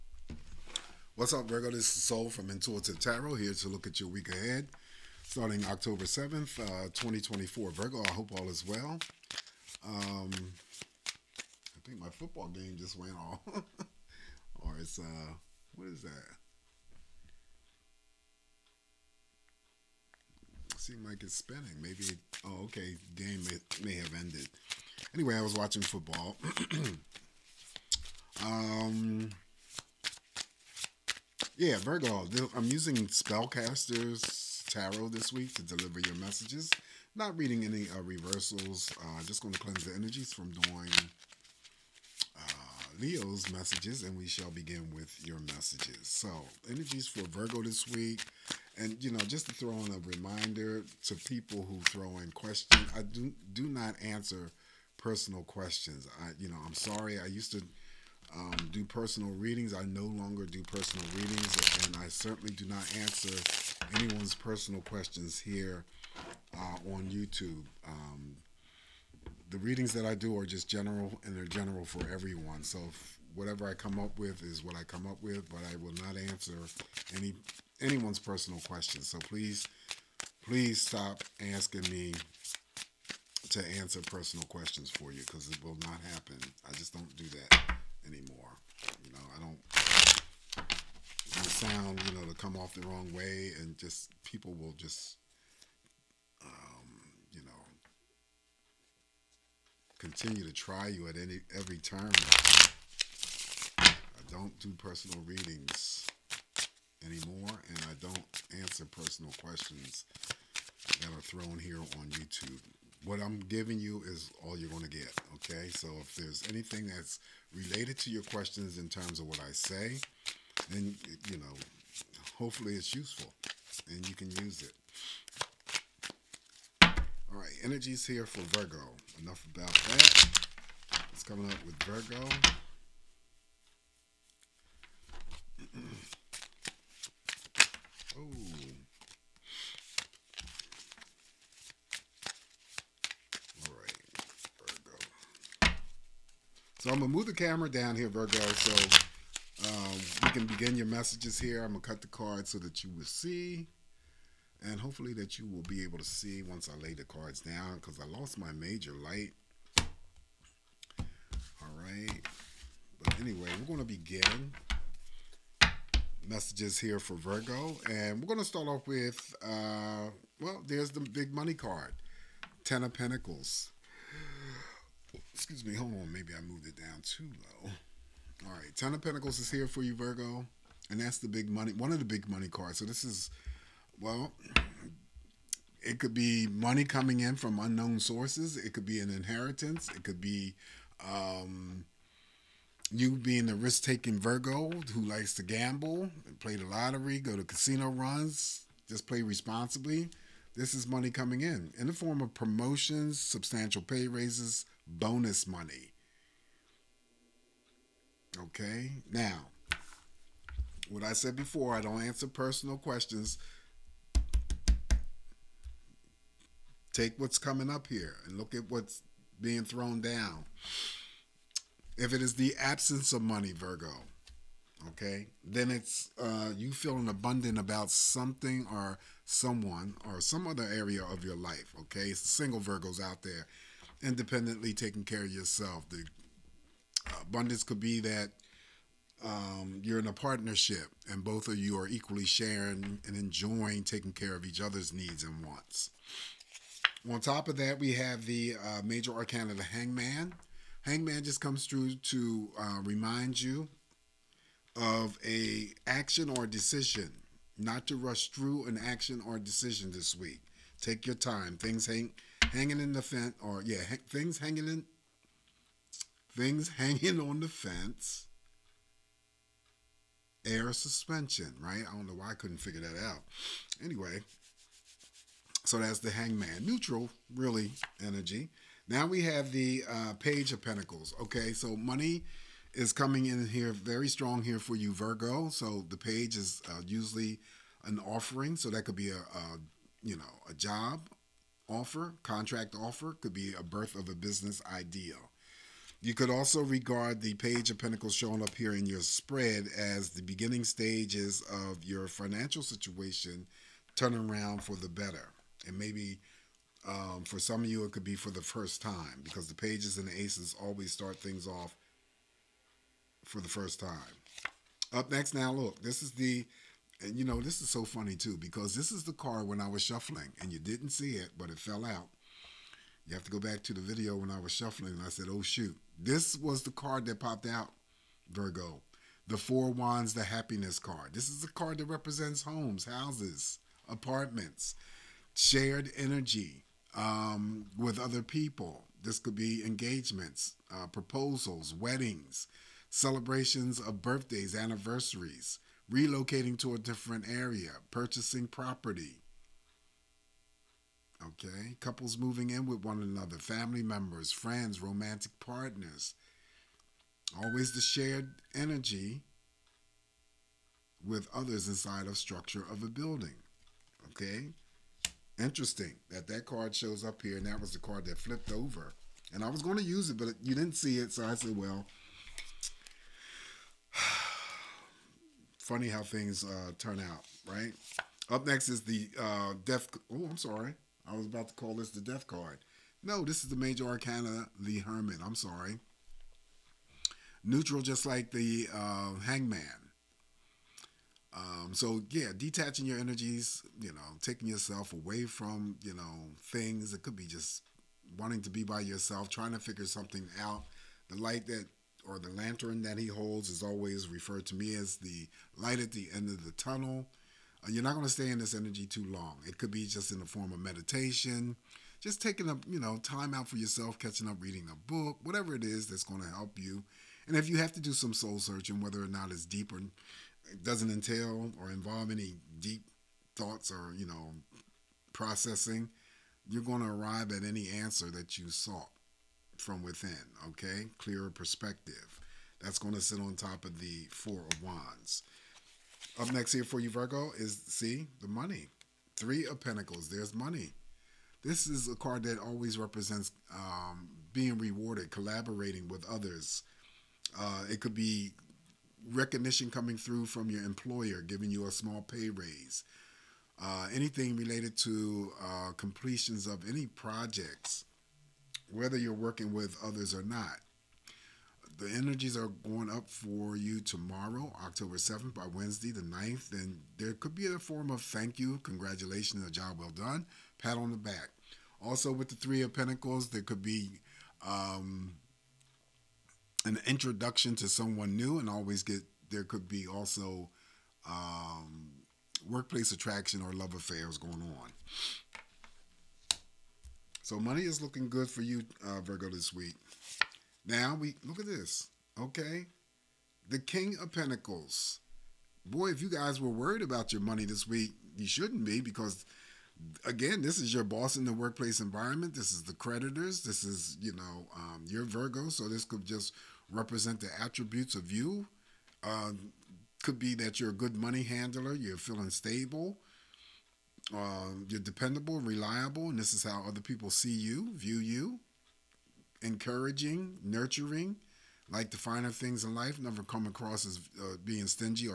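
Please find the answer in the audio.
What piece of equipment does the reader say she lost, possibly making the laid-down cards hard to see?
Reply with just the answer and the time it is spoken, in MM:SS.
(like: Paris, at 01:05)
major light, at 02:38.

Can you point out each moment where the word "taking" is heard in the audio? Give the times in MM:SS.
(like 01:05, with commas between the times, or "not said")
03:13, 03:54, 04:03, 06:34, 06:52.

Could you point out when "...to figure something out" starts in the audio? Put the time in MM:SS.
06:39.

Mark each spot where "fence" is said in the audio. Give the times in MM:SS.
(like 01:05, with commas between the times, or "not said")
04:23, 04:27.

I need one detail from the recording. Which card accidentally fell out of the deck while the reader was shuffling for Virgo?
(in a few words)
Four of Wands.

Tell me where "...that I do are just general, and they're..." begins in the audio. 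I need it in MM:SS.
01:09.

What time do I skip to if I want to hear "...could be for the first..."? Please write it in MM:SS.
05:07.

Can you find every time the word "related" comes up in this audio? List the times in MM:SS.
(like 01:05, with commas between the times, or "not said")
01:57, 07:34.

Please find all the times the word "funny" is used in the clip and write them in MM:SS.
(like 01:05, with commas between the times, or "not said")
05:17, 06:15.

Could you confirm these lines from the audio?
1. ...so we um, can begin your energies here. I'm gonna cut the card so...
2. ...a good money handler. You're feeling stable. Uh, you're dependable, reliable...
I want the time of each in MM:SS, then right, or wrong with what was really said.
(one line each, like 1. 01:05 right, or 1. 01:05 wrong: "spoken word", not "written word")
1. 02:28 wrong: "messages", not "energies"
2. 08:30 right.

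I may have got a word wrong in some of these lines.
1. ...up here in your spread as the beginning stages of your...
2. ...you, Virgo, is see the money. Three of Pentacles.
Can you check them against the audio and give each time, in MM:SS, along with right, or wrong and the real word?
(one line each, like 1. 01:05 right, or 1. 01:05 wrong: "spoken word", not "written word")
1. 04:58 right
2. 07:16 right.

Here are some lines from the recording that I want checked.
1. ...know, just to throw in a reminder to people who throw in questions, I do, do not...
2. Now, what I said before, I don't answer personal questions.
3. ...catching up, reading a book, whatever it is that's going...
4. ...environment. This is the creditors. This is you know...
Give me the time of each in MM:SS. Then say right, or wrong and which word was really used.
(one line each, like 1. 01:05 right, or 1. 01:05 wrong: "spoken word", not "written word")
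1. 00:49 right
2. 03:29 right
3. 06:53 right
4. 08:21 right.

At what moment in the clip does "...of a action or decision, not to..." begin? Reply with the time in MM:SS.
04:14.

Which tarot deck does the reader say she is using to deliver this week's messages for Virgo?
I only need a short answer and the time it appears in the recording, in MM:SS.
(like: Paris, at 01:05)
Spellcasters Tarot, at 00:32.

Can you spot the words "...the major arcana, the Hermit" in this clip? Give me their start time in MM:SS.
06:23.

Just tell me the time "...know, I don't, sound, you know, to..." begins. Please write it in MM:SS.
01:29.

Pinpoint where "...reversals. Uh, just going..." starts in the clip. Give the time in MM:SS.
00:38.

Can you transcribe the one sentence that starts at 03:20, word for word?
This is money coming in in the form of promotions, substantial pay raises, bonus money.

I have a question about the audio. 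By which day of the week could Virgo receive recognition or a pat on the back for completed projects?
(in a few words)
Wednesday.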